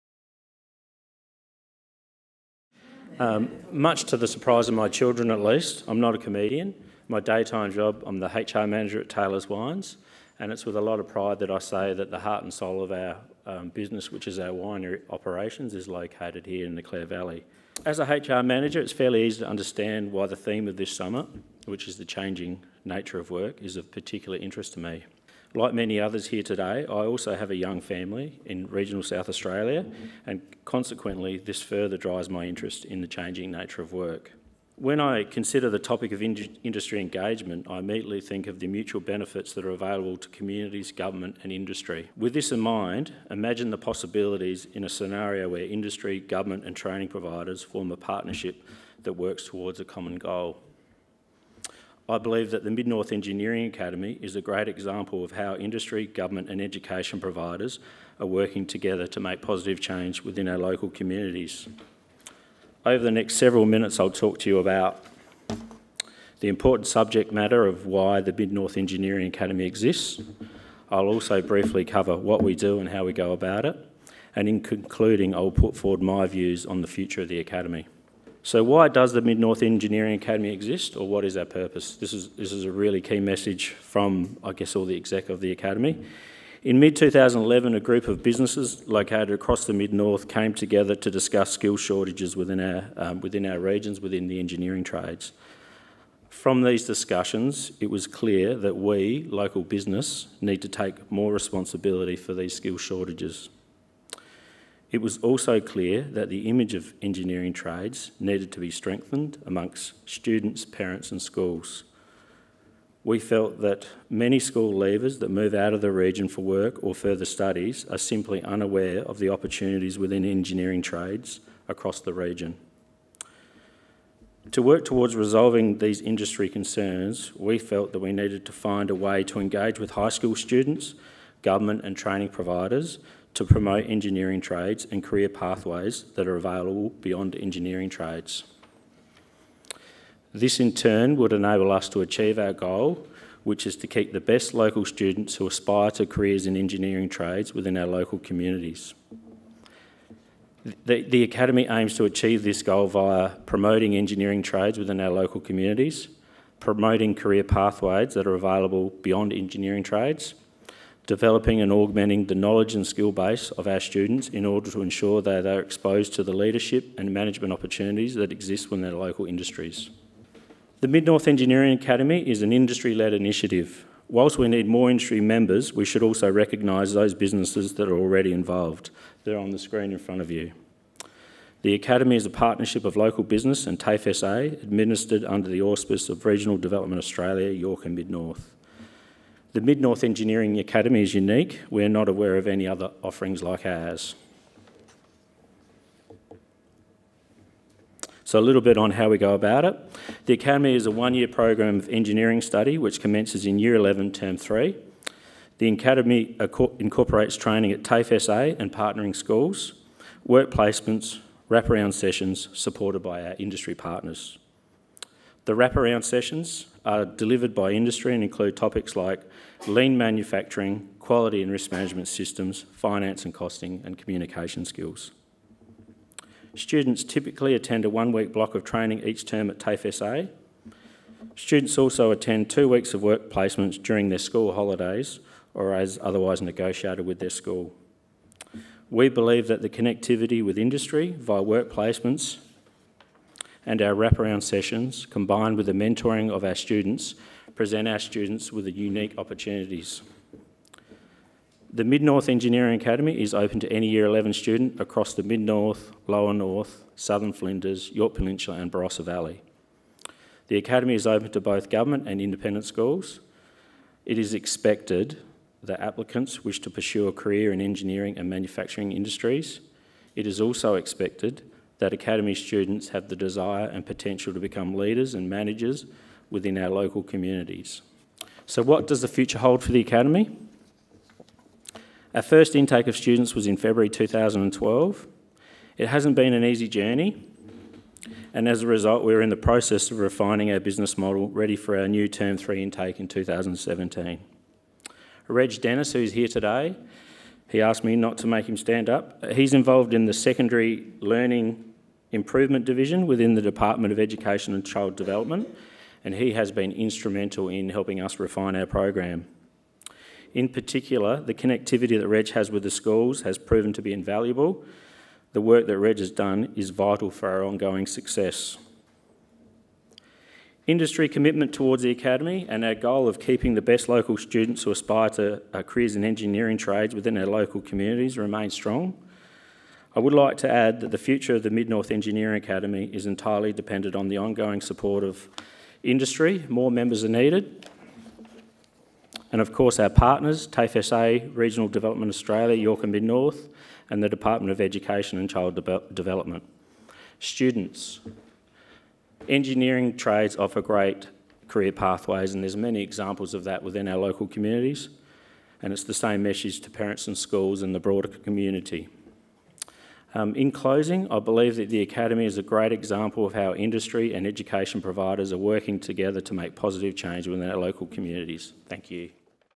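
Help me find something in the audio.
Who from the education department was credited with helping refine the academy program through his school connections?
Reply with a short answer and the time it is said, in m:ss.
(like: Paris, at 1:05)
Reg Dennis, at 4:55.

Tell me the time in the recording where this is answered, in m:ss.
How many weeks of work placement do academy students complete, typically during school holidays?
3:52.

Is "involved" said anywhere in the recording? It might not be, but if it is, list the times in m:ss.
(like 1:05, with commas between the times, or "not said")
2:58, 4:59.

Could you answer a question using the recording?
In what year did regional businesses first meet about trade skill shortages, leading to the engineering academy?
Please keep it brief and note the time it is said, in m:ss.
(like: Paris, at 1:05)
2011, at 1:26.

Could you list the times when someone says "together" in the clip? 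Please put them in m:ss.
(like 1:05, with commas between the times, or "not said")
0:58, 1:30, 6:05.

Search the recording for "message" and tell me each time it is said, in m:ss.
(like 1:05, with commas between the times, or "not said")
1:23, 5:56.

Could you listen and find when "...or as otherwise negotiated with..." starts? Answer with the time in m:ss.
3:55.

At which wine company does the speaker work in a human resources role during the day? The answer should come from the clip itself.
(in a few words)
Taylor's Wines.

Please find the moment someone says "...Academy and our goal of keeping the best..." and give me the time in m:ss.
5:21.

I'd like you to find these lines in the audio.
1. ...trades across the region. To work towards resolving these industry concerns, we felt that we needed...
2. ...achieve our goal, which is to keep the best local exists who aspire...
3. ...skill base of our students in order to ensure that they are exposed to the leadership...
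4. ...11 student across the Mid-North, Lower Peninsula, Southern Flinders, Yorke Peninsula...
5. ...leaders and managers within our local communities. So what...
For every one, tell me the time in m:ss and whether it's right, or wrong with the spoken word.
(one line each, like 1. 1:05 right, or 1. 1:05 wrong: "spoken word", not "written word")
1. 2:00 right
2. 2:22 wrong: "students", not "exists"
3. 2:42 right
4. 4:14 wrong: "North", not "Peninsula"
5. 4:34 right.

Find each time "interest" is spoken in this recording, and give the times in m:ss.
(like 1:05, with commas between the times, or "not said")
0:24, 0:32.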